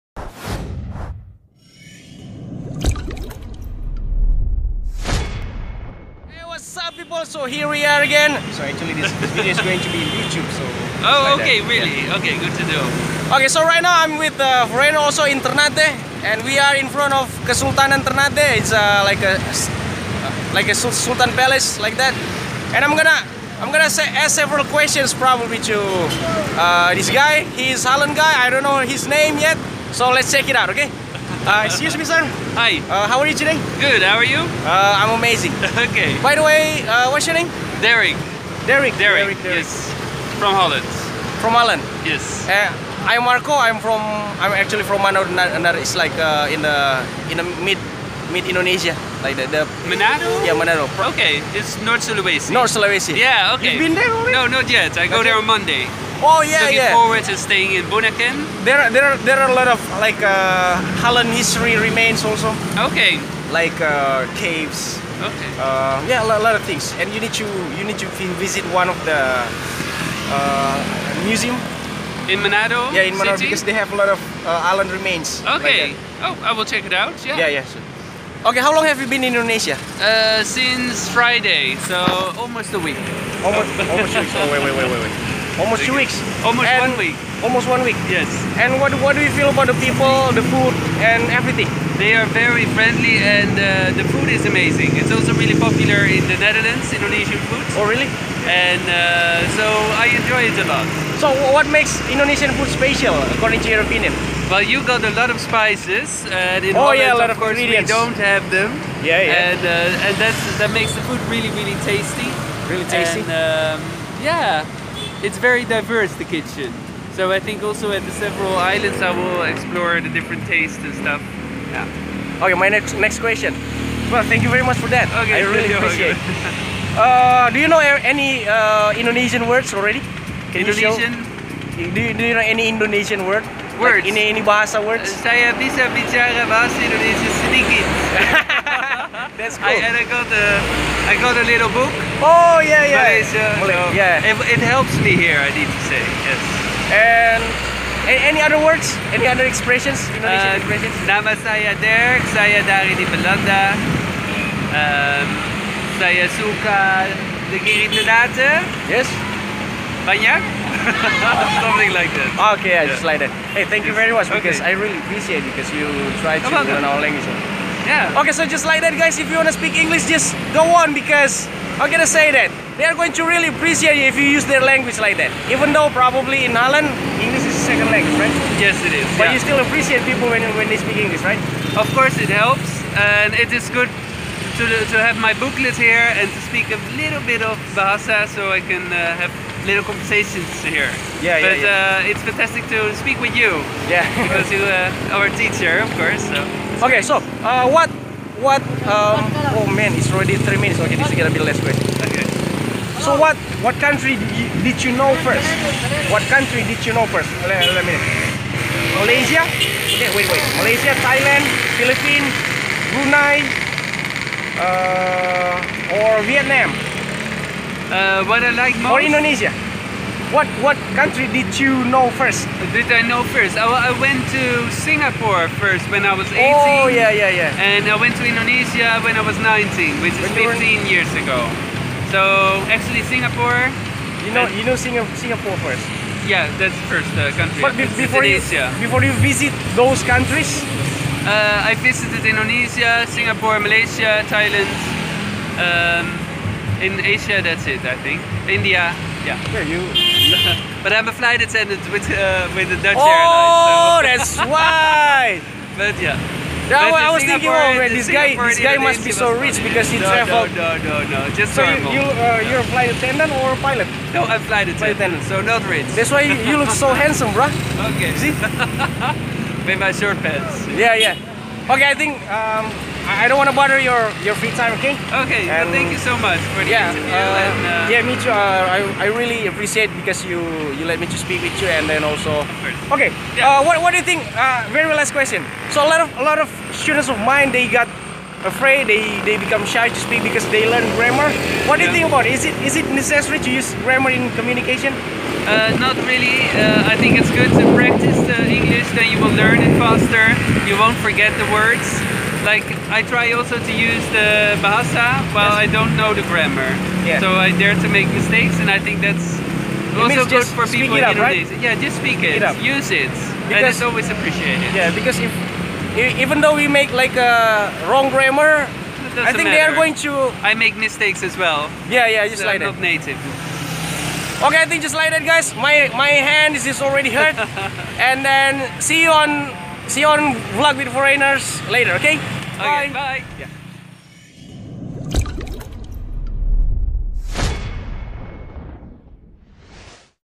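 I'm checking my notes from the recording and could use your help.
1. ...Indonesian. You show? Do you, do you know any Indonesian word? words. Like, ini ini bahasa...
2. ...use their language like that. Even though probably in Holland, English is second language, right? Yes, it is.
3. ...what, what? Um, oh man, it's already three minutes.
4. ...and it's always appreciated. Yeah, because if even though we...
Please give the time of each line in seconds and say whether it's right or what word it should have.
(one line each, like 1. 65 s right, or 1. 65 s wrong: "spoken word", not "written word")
1. 130 s right
2. 174 s right
3. 197 s right
4. 313 s right.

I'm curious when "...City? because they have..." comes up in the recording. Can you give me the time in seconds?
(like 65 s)
73 s.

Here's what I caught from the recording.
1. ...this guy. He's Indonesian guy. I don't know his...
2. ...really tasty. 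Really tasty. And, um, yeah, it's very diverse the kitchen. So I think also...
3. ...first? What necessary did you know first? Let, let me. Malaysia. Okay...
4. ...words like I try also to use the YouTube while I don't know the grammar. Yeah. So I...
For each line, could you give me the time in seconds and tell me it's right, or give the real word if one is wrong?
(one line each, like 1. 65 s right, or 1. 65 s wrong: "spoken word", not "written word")
1. 26 s wrong: "Holland", not "Indonesian"
2. 111 s right
3. 205 s wrong: "country", not "necessary"
4. 301 s wrong: "Bahasa", not "YouTube".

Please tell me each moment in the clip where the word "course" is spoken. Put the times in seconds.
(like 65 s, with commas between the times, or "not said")
107 s, 181 s, 195 s.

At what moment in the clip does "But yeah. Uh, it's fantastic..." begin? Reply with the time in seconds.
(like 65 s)
191 s.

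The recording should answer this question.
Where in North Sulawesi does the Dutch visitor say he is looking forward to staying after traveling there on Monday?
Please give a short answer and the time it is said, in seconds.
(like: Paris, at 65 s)
Bunaken, at 57 s.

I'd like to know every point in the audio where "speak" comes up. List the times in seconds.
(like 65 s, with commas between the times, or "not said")
169 s, 180 s, 186 s, 192 s, 281 s, 290 s, 311 s.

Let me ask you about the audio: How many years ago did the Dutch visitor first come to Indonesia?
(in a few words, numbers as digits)
15.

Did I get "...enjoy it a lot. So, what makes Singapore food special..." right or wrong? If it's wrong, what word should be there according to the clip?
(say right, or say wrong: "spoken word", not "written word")
wrong: "Indonesian", not "Singapore".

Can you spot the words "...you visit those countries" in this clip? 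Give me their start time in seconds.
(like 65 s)
239 s.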